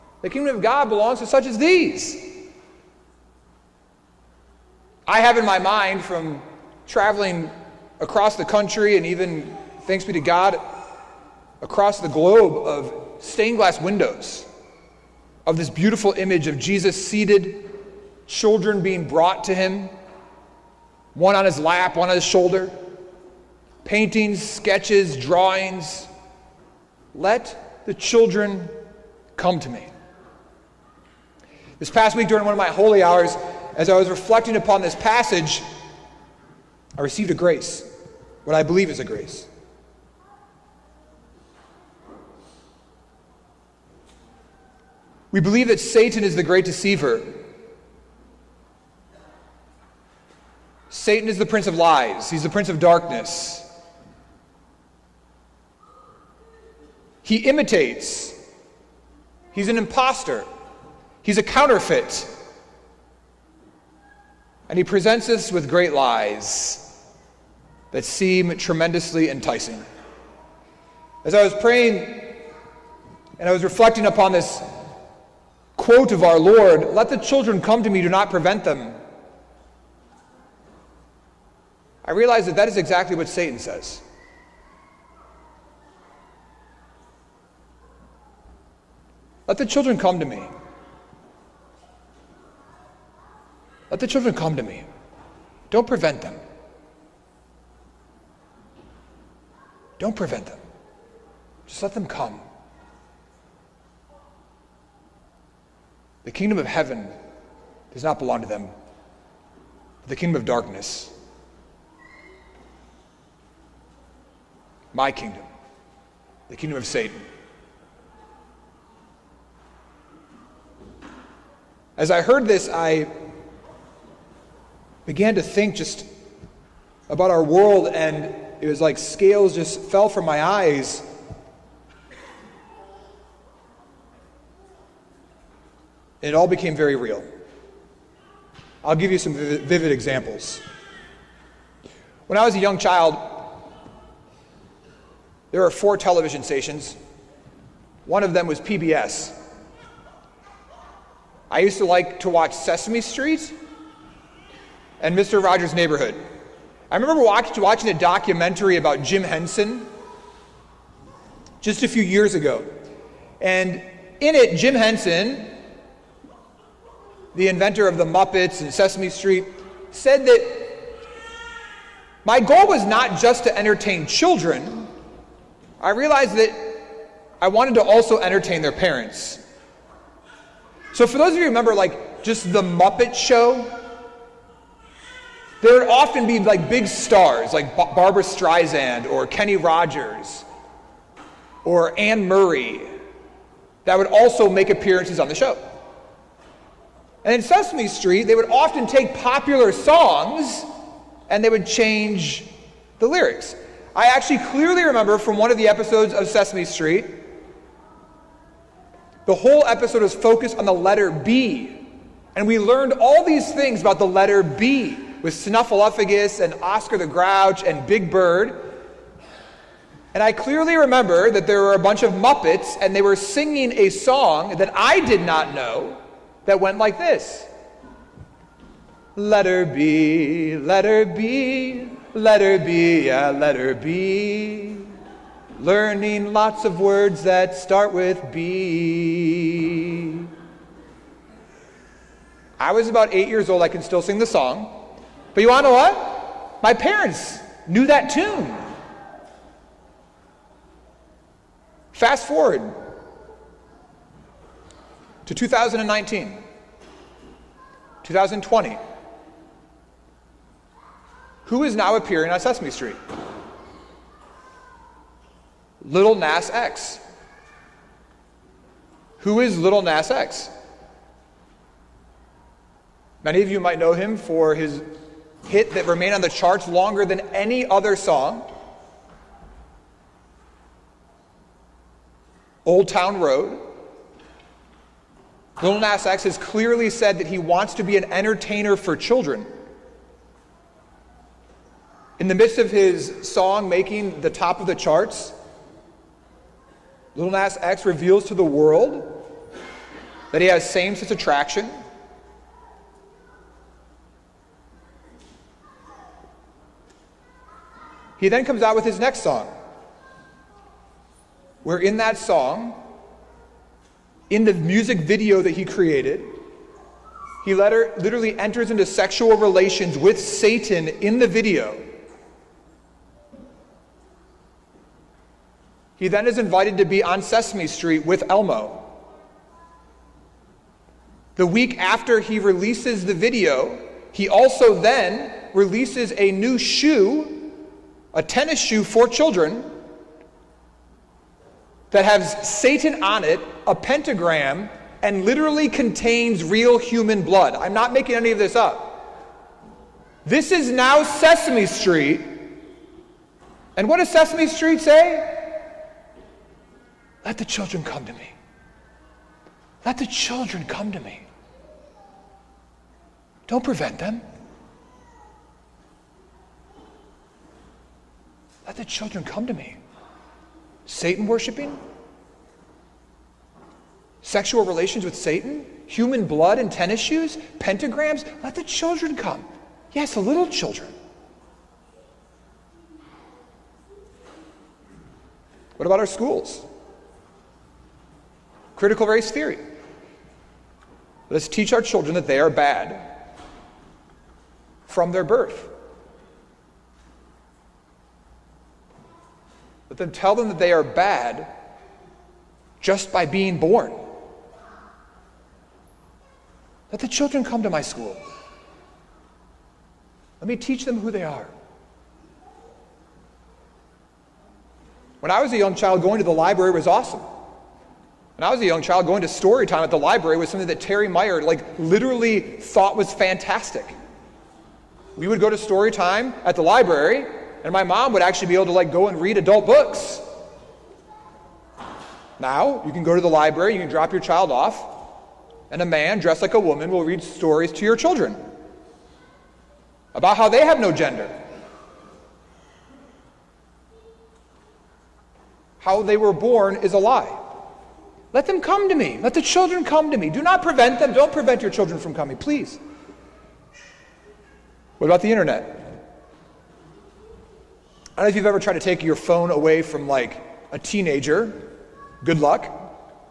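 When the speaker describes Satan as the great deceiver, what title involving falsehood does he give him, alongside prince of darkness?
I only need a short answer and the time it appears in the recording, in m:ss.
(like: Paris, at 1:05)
Prince of lies, at 0:51.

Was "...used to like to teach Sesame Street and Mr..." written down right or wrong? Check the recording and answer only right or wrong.
wrong.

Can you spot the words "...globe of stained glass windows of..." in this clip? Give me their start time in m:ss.
0:12.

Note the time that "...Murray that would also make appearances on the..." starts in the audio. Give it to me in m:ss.
3:12.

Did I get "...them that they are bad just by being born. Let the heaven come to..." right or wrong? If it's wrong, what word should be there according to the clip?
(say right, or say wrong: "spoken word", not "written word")
wrong: "children", not "heaven".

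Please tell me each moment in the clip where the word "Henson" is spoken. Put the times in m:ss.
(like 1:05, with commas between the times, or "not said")
2:39, 2:44.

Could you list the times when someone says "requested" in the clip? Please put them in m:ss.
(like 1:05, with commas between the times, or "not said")
not said.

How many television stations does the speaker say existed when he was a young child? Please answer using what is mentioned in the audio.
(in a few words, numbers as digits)
4.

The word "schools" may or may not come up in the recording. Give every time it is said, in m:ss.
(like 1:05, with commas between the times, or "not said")
6:26, 6:47.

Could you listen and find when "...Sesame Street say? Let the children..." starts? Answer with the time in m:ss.
5:54.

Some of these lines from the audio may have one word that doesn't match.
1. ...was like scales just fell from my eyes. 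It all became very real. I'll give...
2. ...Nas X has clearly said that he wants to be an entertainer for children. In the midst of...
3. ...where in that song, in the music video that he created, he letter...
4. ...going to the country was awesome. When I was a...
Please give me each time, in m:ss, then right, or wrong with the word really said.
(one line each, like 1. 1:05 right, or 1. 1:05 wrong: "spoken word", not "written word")
1. 2:08 right
2. 4:45 right
3. 5:11 right
4. 6:55 wrong: "library", not "country".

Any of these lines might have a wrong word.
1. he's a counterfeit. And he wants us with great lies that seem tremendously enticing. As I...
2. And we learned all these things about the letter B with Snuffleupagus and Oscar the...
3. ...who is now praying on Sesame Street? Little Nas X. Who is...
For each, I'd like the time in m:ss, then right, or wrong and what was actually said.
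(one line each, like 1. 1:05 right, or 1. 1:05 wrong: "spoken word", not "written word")
1. 1:01 wrong: "presents", not "wants"
2. 3:32 right
3. 4:21 wrong: "appearing", not "praying".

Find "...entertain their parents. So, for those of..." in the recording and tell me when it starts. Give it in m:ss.
2:58.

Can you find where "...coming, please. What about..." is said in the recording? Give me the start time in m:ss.
7:32.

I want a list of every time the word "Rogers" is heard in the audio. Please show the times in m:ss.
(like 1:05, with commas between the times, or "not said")
2:35, 3:09.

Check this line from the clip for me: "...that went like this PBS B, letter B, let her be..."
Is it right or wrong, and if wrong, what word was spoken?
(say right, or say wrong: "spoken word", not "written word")
wrong: "Letter", not "PBS".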